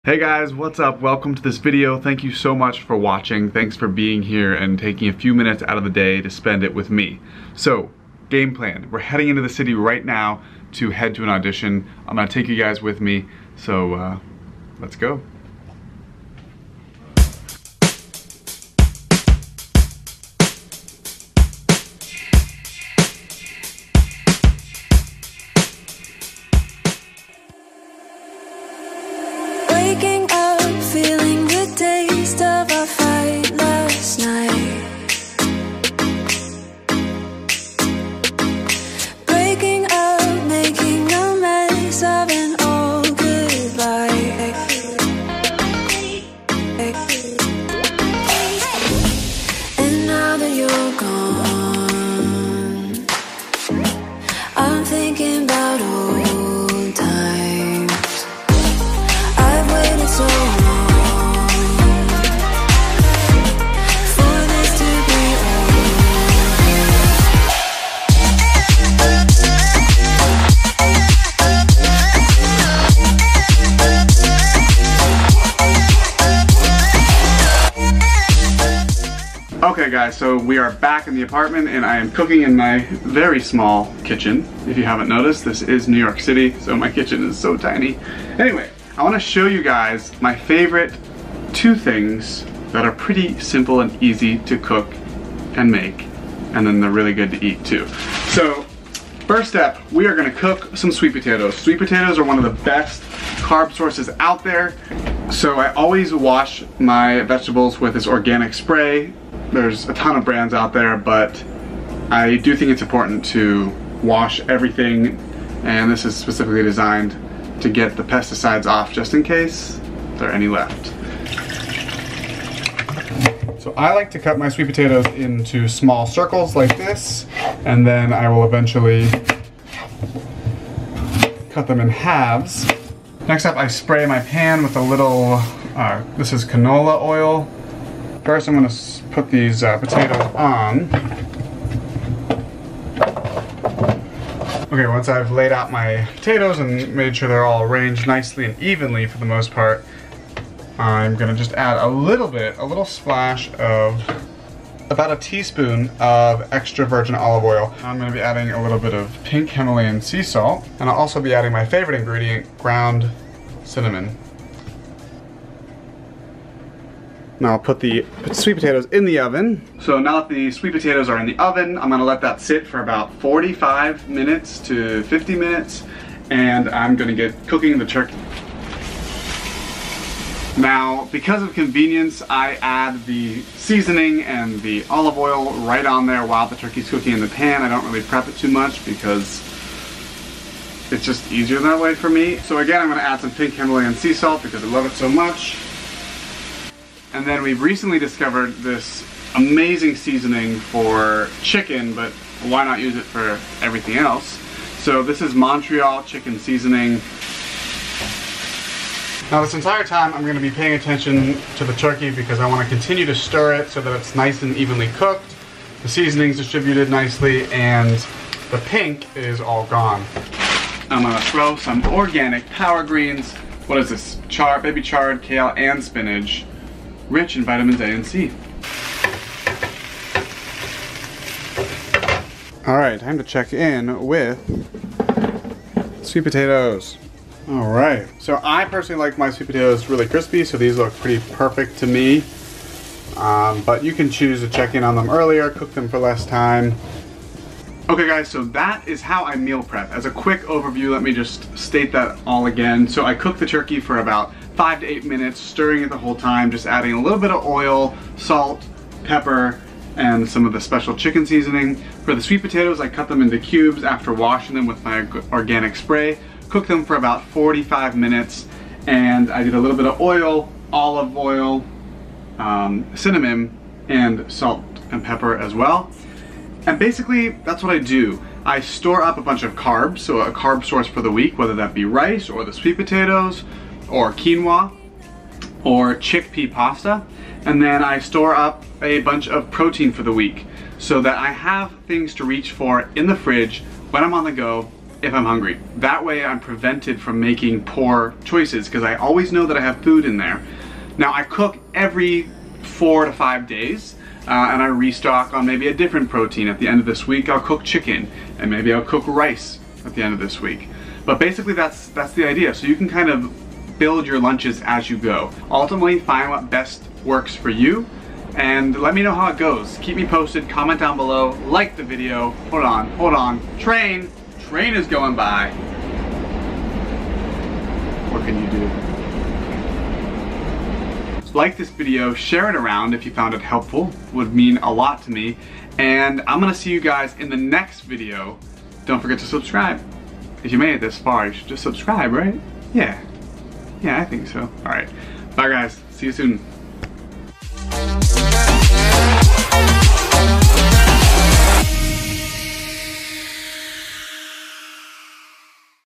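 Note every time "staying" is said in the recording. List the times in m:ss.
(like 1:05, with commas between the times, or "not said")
not said.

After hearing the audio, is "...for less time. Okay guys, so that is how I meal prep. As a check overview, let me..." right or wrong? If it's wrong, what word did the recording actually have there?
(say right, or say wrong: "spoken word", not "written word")
wrong: "quick", not "check".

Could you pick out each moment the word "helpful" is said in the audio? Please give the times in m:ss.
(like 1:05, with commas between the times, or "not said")
5:33.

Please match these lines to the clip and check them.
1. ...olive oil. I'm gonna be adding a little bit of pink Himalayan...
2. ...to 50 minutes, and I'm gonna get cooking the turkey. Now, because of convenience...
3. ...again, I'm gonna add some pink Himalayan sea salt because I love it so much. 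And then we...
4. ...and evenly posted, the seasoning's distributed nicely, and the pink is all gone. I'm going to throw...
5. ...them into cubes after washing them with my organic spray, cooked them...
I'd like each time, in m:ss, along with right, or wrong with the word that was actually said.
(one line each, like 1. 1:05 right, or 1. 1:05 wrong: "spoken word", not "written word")
1. 2:37 right
2. 2:54 right
3. 3:12 right
4. 3:34 wrong: "cooked", not "posted"
5. 4:23 right.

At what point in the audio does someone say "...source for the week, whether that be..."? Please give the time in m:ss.
4:40.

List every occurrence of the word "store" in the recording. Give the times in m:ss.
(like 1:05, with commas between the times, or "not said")
4:38, 4:47.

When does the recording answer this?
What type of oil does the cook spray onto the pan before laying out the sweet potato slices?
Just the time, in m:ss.
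2:16.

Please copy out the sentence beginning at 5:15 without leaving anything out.
Ultimately, find what best works for you and let me know how it goes.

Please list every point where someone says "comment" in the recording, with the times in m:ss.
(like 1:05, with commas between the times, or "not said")
5:20.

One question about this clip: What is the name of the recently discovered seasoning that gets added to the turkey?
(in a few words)
Montreal chicken seasoning.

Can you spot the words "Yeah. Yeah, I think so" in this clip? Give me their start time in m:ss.
5:42.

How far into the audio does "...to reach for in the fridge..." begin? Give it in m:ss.
4:52.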